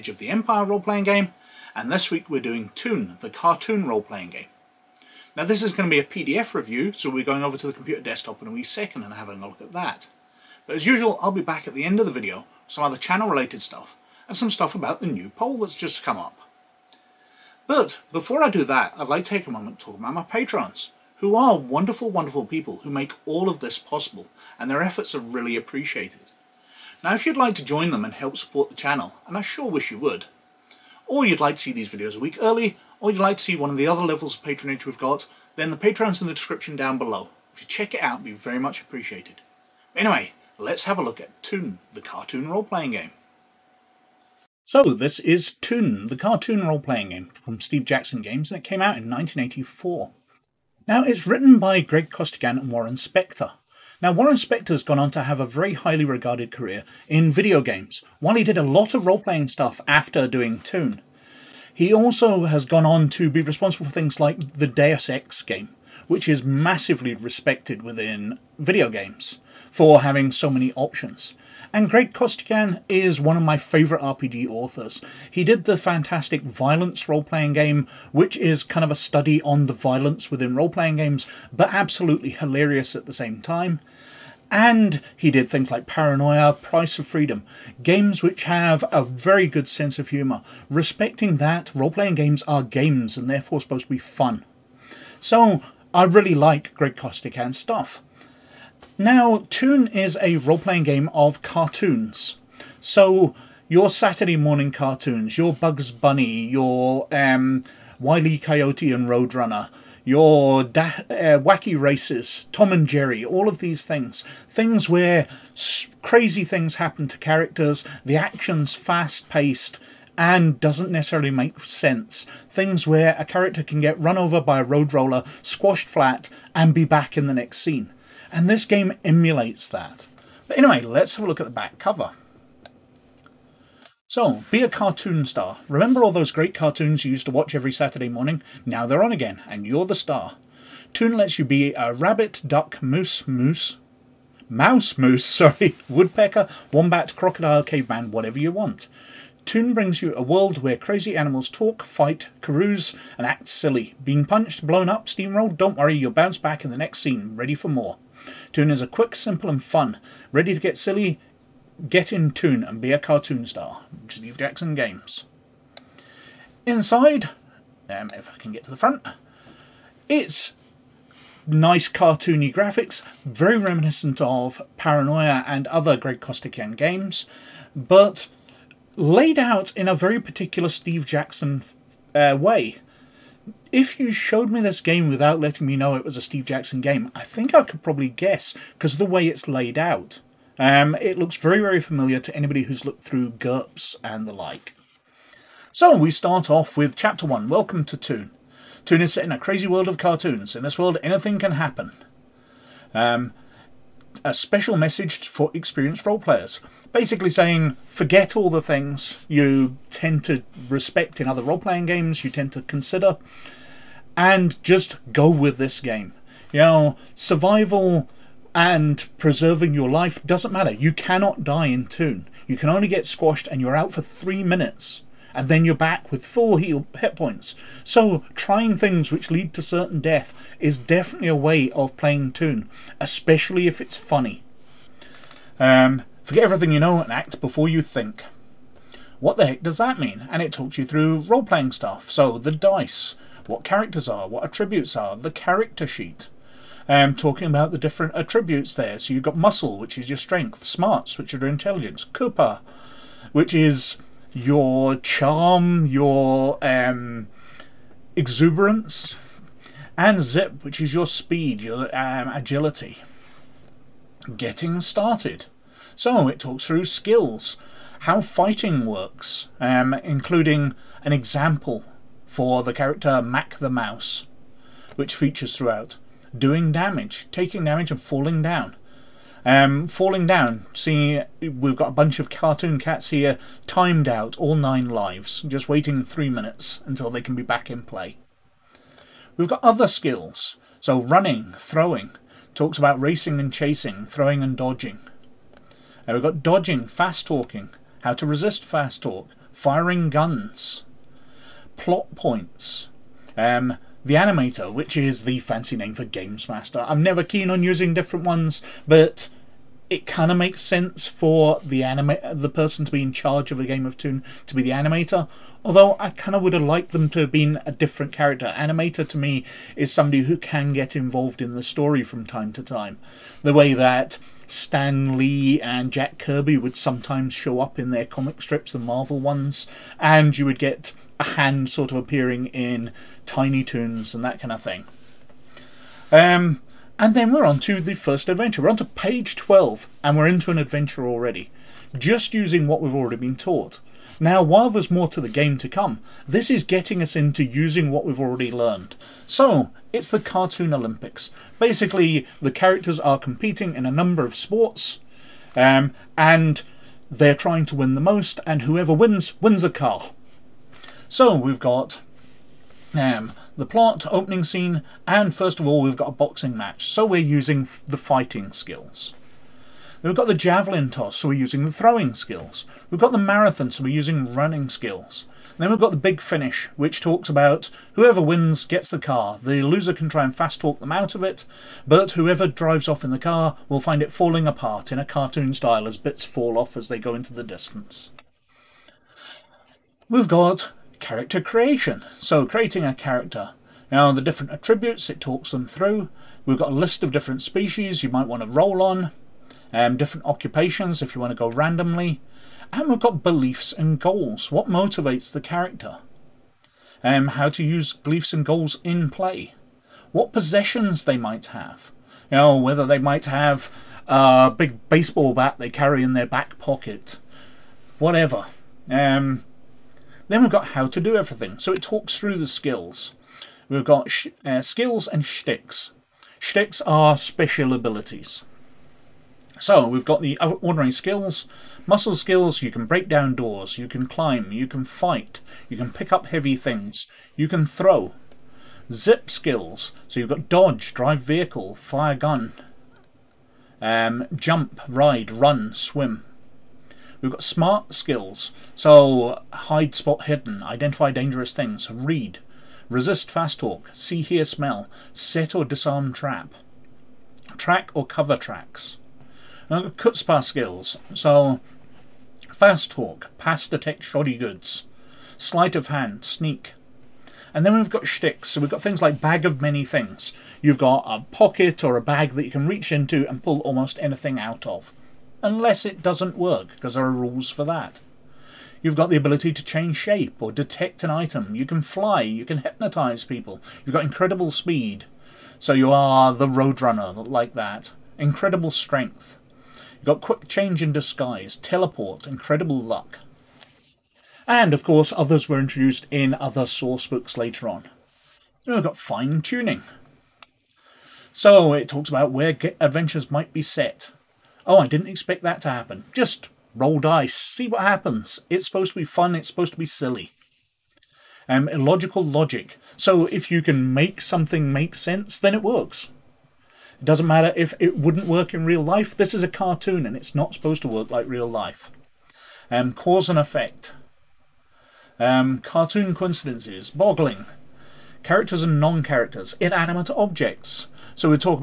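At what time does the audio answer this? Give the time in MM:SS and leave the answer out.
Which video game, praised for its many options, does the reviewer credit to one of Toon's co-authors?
01:04.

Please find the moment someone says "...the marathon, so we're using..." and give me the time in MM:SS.
06:13.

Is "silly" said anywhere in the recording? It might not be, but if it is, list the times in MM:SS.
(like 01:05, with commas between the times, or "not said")
02:33, 02:40, 08:29.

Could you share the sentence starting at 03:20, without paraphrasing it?
In this world, anything can happen.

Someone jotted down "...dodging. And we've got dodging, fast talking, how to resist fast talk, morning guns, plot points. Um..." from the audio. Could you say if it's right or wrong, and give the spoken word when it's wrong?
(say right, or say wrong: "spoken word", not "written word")
wrong: "firing", not "morning".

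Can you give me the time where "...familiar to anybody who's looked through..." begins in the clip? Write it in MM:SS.
03:11.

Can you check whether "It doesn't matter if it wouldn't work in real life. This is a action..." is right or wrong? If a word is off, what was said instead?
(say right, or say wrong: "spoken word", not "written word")
wrong: "cartoon", not "action".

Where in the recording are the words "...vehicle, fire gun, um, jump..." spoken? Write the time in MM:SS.
07:21.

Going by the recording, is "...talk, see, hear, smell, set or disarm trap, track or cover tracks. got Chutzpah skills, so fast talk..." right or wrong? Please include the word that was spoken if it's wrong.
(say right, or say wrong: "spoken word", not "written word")
right.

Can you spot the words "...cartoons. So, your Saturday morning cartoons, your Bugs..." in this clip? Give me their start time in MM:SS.
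01:41.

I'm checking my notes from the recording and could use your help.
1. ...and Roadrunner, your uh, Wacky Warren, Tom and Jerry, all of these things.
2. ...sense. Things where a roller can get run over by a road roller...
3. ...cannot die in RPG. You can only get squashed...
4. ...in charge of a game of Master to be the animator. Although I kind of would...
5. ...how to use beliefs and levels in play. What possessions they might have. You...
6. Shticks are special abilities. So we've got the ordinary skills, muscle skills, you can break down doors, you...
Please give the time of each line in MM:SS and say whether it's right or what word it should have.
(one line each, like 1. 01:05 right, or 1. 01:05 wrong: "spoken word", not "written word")
1. 01:48 wrong: "Races", not "Warren"
2. 02:01 wrong: "character", not "roller"
3. 03:40 wrong: "Toon", not "RPG"
4. 05:13 wrong: "Toon", not "Master"
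5. 06:47 wrong: "goals", not "levels"
6. 07:06 right.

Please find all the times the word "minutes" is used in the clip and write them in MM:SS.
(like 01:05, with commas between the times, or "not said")
03:44, 04:46.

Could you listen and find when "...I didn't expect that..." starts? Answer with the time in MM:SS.
08:24.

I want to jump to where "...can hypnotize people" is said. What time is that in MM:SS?
08:02.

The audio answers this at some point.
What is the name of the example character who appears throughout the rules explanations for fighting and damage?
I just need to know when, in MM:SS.
04:33.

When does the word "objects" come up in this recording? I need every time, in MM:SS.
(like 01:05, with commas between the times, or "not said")
08:50.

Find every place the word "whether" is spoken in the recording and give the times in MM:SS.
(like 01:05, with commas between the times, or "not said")
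06:52.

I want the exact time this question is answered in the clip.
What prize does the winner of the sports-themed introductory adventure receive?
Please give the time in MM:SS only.
05:59.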